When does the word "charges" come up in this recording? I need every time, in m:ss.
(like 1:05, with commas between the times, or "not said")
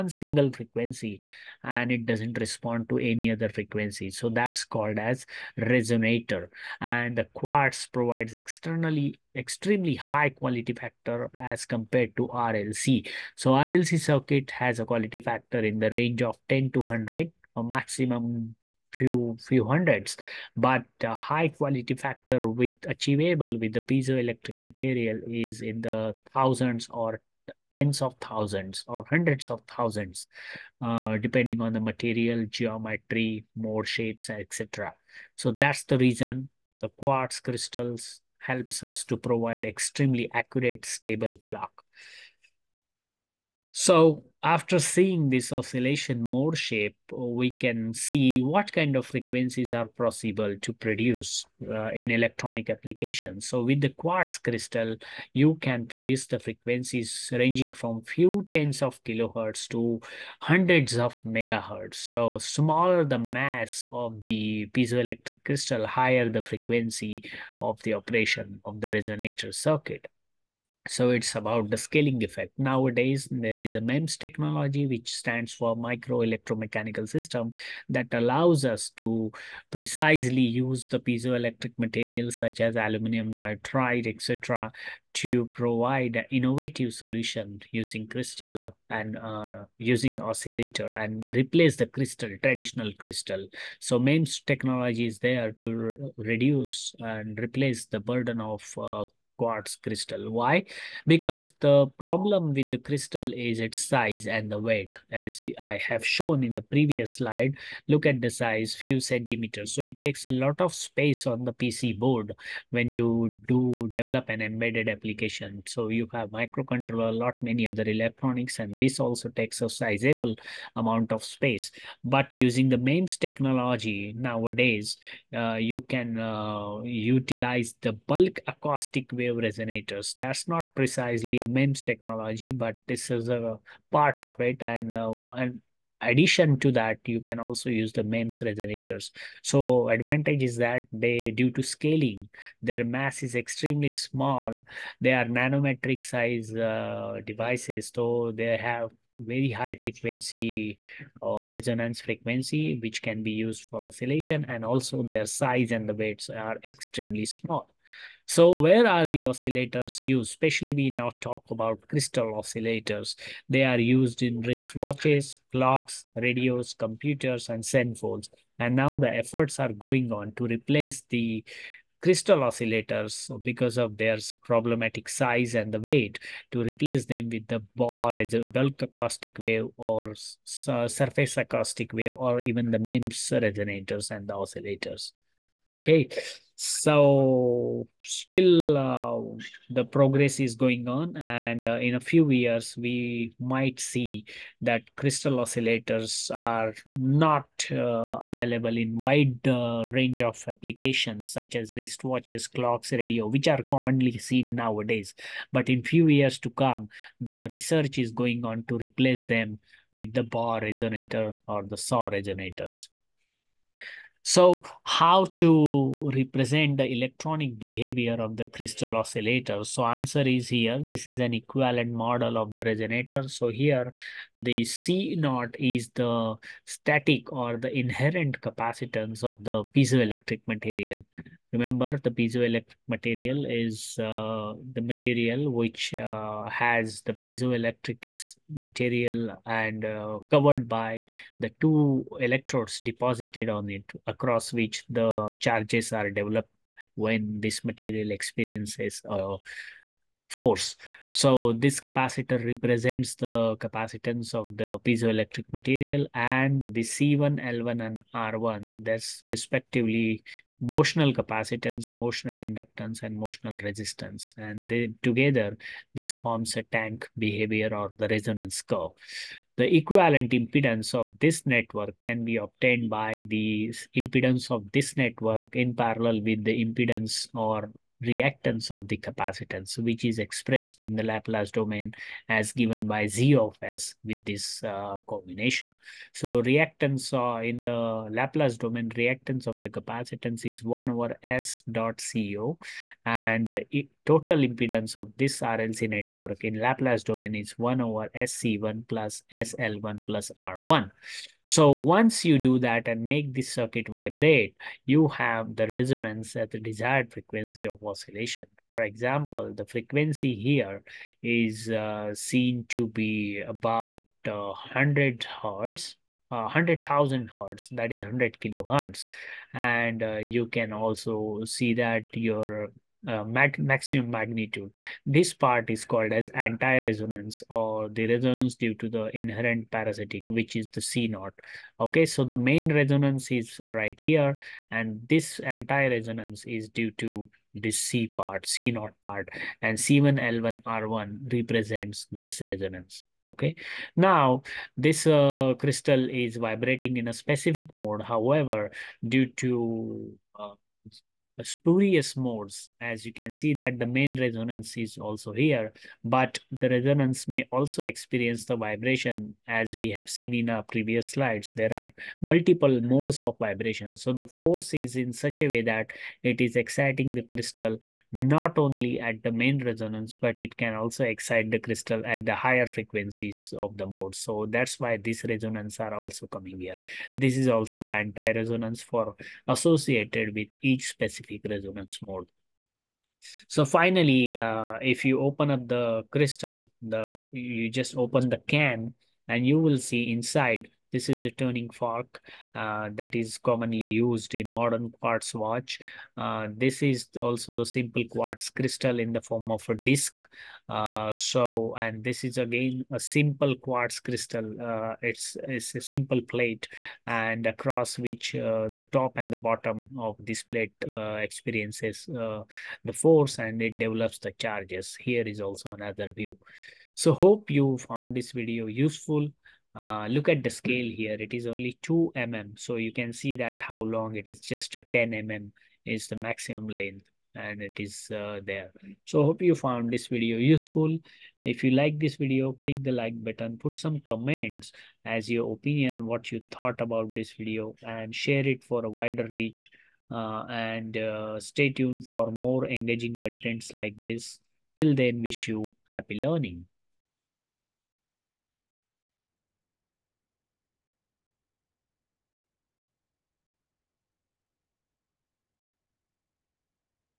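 4:05, 6:54.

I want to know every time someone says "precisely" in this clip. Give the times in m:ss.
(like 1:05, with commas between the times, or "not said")
1:19, 2:10.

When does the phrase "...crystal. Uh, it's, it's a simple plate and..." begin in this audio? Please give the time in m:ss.
6:43.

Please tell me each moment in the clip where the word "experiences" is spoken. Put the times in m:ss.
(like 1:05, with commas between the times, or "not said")
4:08, 5:57, 6:51.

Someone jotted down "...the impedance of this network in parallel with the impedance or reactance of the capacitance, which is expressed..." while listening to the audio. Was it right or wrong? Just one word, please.
right.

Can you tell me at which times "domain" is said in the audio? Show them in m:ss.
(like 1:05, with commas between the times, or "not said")
4:41, 4:48, 4:57.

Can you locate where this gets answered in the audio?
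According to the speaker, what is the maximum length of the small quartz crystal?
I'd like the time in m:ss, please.
7:04.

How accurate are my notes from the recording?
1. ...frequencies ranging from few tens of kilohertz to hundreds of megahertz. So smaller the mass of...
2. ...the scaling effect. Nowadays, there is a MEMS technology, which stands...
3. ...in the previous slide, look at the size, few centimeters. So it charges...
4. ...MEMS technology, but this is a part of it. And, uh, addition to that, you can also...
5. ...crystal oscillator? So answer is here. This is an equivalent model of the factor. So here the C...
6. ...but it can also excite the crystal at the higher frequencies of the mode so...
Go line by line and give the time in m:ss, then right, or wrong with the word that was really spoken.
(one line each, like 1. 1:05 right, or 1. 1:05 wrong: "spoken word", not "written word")
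1. 0:56 right
2. 1:11 right
3. 1:46 wrong: "takes", not "charges"
4. 2:11 right
5. 3:38 wrong: "resonator", not "factor"
6. 6:10 right.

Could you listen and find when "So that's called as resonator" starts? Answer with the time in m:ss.
0:04.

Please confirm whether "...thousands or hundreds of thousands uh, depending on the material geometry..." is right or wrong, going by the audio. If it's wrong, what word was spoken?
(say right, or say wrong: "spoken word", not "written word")
right.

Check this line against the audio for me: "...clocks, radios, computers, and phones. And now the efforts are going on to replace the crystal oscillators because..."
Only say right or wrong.
right.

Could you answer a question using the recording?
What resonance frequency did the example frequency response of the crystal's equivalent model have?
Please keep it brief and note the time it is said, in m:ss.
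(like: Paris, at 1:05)
100 kilohertz, at 5:18.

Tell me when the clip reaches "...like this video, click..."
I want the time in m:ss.
7:11.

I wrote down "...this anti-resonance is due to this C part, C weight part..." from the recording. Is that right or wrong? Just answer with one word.
wrong.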